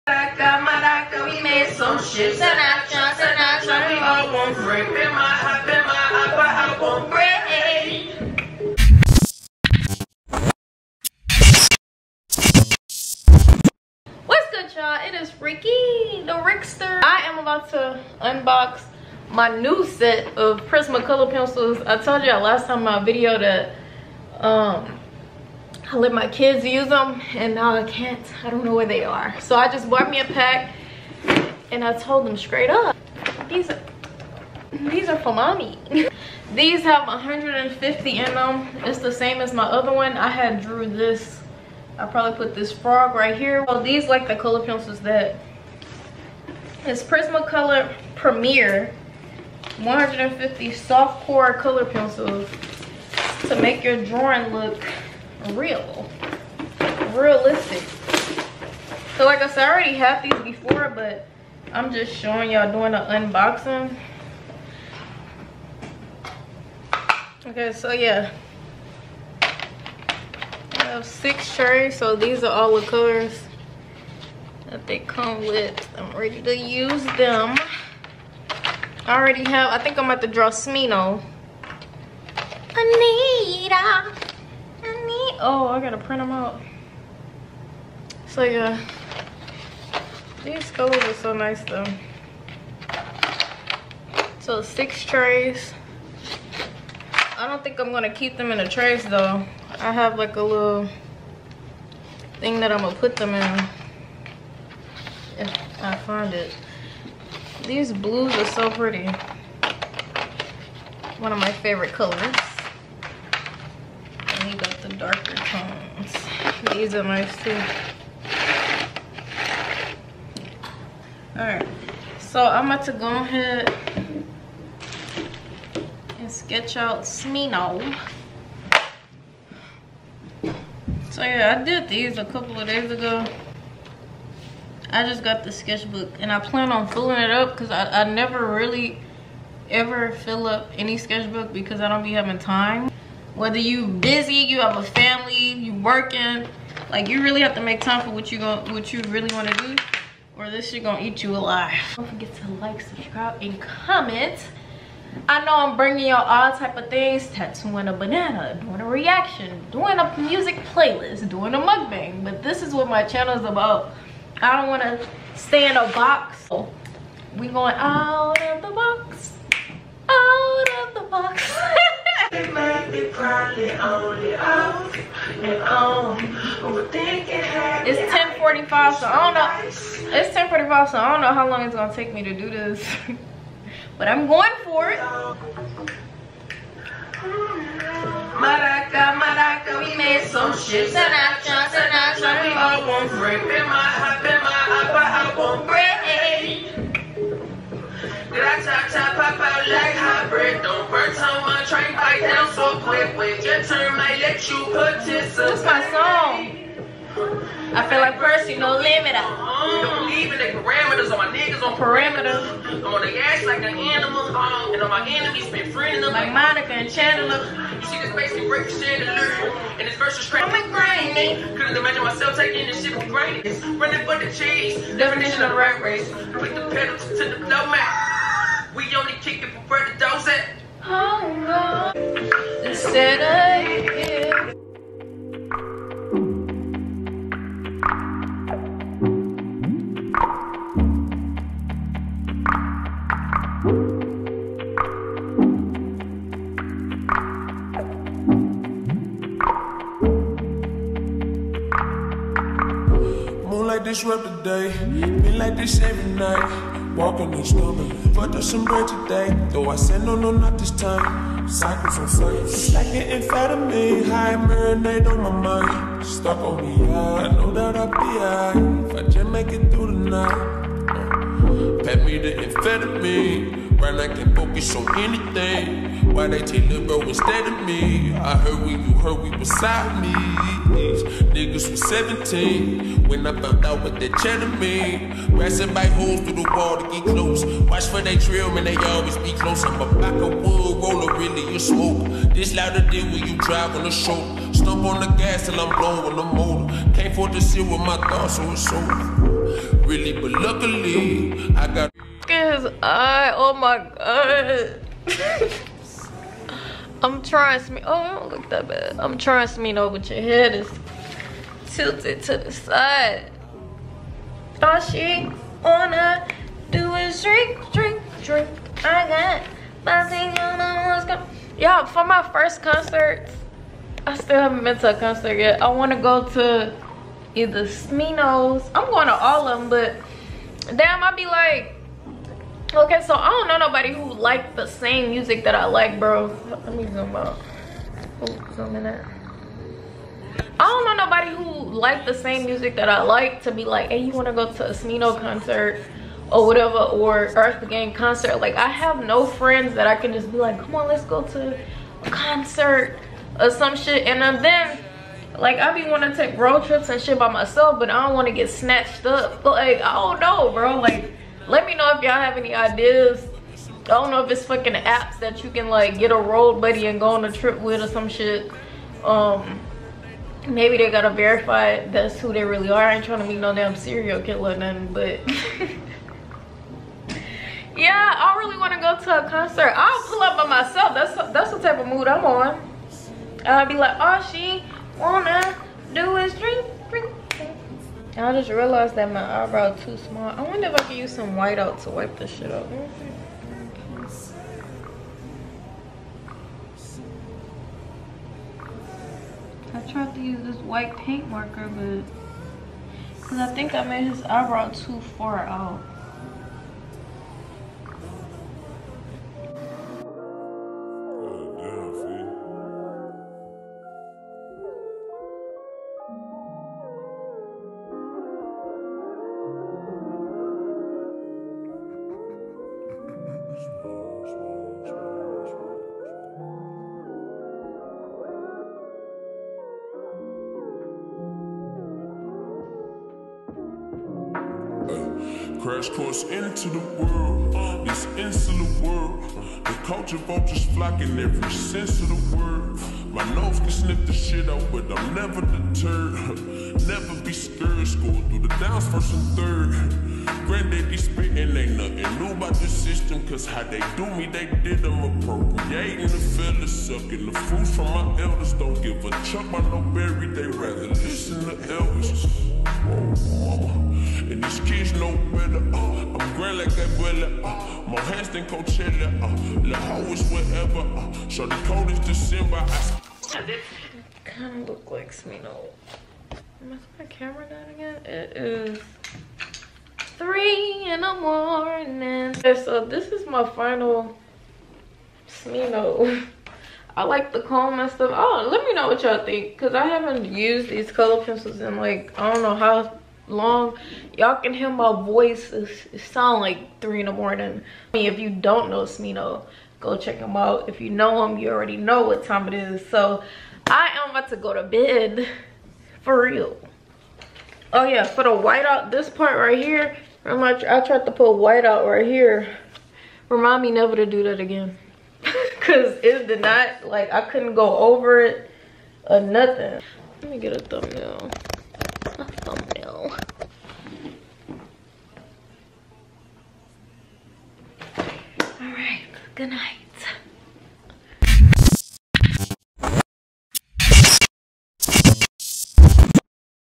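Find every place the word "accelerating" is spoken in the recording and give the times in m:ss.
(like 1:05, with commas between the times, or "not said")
not said.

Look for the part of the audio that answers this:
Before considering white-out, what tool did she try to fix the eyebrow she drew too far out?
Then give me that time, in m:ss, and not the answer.
6:40.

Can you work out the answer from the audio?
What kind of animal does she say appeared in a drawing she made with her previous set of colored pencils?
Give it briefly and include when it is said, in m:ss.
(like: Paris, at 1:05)
Frog, at 0:42.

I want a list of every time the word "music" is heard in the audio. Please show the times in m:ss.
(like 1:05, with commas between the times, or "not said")
2:40, 5:35, 5:42.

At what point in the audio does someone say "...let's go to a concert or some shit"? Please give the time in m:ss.
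5:50.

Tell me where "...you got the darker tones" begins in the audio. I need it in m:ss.
1:54.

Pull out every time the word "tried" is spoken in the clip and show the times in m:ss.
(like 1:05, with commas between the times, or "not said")
6:39, 8:30.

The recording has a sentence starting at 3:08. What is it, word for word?
Maraca, maraca, we made some shit.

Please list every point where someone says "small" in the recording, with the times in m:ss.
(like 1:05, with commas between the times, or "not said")
6:29.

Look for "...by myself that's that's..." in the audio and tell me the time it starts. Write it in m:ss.
6:20.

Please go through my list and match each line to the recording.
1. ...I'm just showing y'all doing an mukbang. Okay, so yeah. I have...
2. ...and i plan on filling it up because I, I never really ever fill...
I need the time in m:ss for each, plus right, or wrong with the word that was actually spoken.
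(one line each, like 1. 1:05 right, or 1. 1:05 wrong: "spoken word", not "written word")
1. 1:01 wrong: "unboxing", not "mukbang"
2. 2:16 right.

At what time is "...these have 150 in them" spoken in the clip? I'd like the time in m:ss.
0:36.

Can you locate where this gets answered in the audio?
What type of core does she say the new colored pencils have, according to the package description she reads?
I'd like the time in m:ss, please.
0:50.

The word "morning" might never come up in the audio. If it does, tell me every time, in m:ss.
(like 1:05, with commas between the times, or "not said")
8:01, 8:17.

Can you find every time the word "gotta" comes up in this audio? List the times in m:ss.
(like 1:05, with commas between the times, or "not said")
1:25, 6:10.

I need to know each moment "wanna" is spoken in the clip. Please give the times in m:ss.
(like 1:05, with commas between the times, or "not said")
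2:44, 5:15, 6:24.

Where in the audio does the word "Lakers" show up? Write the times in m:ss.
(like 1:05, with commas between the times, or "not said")
not said.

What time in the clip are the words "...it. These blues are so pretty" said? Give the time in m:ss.
1:46.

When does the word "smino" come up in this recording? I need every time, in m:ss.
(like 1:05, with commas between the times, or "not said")
1:20, 2:07, 5:09, 5:27, 5:44, 7:55, 8:05, 8:18.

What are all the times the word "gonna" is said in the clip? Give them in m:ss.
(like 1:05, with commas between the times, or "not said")
1:37, 1:42, 2:30, 3:01.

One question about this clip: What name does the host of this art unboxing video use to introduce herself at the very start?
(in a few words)
Ricki.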